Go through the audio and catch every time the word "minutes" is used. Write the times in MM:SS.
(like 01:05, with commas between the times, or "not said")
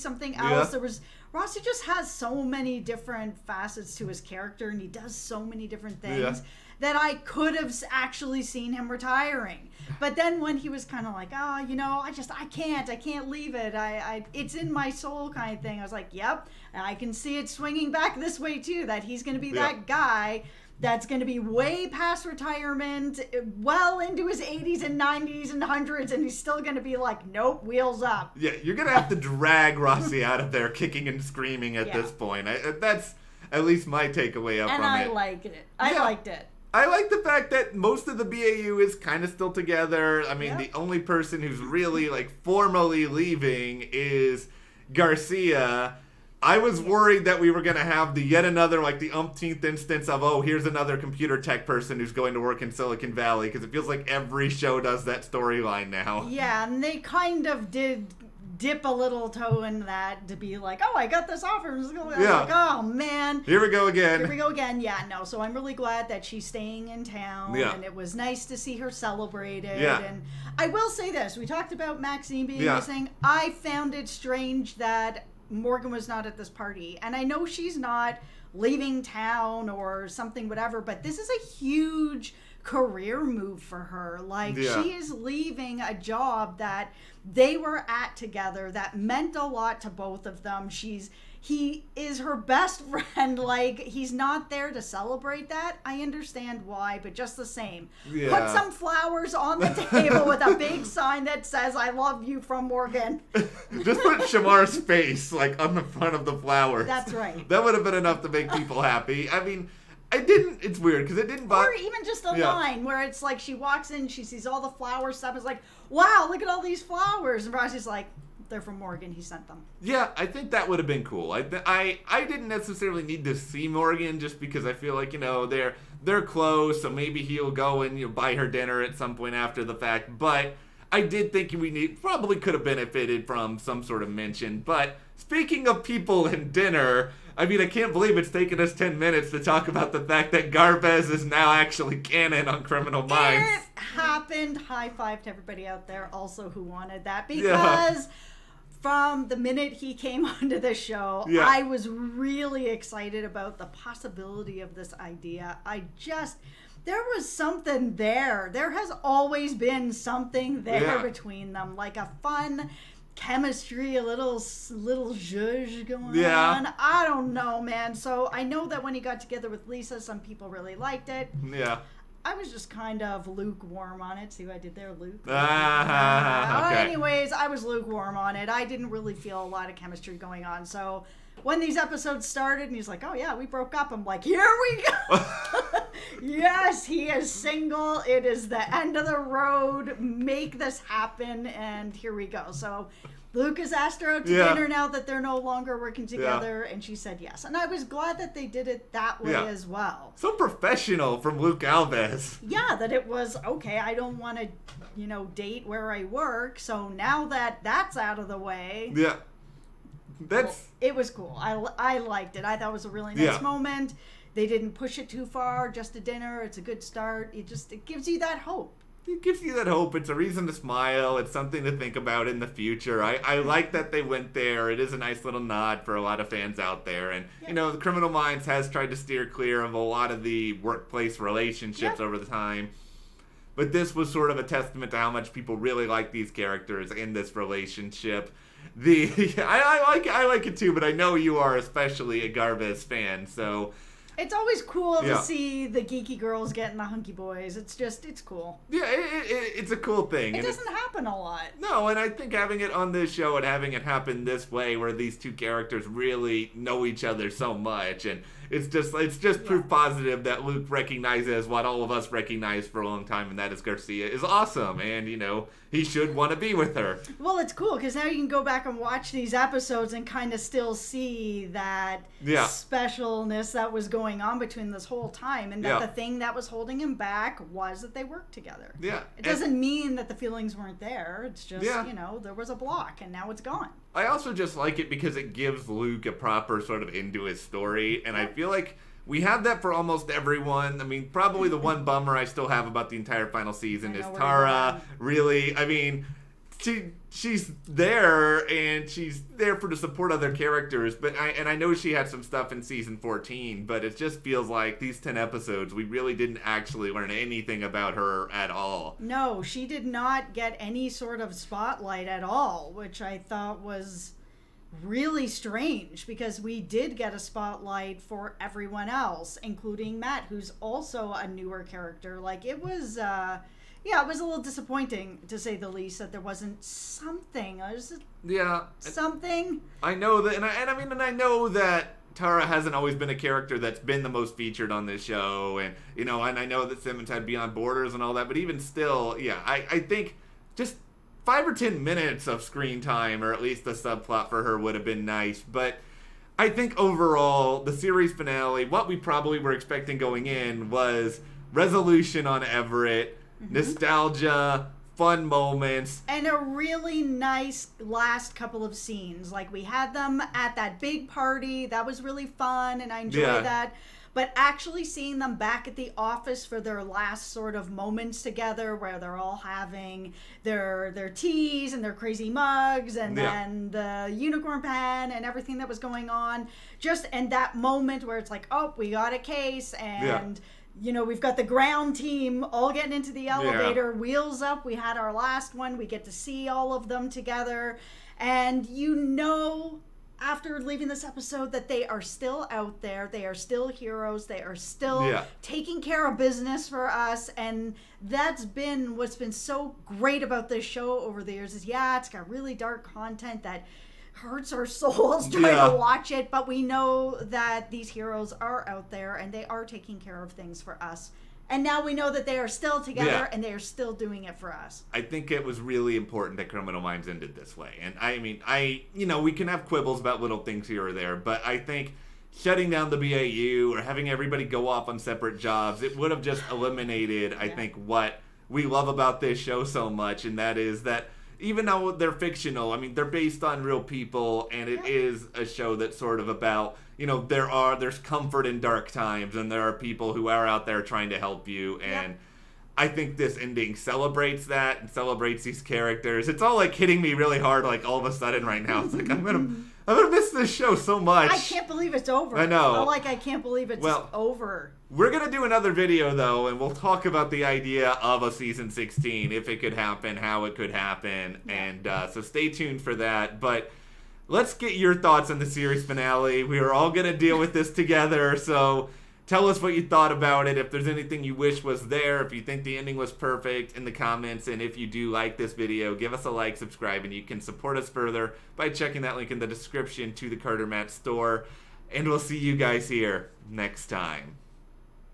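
02:18, 02:29, 05:41.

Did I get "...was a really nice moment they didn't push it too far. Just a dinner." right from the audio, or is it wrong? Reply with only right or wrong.
right.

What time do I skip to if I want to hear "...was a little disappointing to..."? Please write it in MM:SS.
05:24.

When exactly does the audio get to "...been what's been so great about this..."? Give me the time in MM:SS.
06:38.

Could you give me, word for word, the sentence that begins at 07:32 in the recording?
I'm like I can't believe it's well, over.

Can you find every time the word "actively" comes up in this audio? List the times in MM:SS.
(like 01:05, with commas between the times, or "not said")
not said.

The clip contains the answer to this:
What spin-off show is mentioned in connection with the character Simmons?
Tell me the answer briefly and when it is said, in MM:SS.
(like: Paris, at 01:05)
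Beyond Borders, at 05:37.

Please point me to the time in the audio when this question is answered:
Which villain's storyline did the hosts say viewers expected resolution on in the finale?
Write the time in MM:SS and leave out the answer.
05:52.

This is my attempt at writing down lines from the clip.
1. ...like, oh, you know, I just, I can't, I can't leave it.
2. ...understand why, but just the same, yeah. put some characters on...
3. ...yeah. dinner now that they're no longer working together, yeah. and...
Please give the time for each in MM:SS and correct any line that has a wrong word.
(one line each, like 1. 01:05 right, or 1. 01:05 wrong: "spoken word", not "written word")
1. 00:11 right
2. 01:36 wrong: "flowers", not "characters"
3. 03:14 right.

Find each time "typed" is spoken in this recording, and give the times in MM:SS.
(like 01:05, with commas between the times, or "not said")
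not said.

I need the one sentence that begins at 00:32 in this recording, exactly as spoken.
I, uh, that's at least my takeaway up and from I it.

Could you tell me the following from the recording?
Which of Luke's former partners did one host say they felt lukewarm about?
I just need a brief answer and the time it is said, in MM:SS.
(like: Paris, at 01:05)
Lisa, at 02:49.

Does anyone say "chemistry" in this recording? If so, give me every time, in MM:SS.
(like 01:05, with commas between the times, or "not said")
02:43, 02:59.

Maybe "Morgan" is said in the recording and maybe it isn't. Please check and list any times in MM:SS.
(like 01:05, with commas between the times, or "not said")
01:15, 01:42, 01:58, 02:03.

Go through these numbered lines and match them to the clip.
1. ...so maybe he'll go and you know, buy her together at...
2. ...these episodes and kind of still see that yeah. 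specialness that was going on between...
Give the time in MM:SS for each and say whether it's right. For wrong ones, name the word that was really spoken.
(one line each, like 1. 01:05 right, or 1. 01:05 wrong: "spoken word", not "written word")
1. 02:06 wrong: "dinner", not "together"
2. 04:29 right.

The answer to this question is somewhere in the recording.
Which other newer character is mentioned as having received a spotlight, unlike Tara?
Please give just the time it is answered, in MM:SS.
05:19.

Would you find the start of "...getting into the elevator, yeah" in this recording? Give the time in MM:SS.
06:22.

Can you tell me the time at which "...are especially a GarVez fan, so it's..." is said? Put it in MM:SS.
04:01.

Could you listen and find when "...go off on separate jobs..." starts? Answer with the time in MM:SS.
07:04.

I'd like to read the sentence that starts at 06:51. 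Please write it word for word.
And now we know that they are still together yeah.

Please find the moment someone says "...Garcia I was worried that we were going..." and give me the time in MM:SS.
00:44.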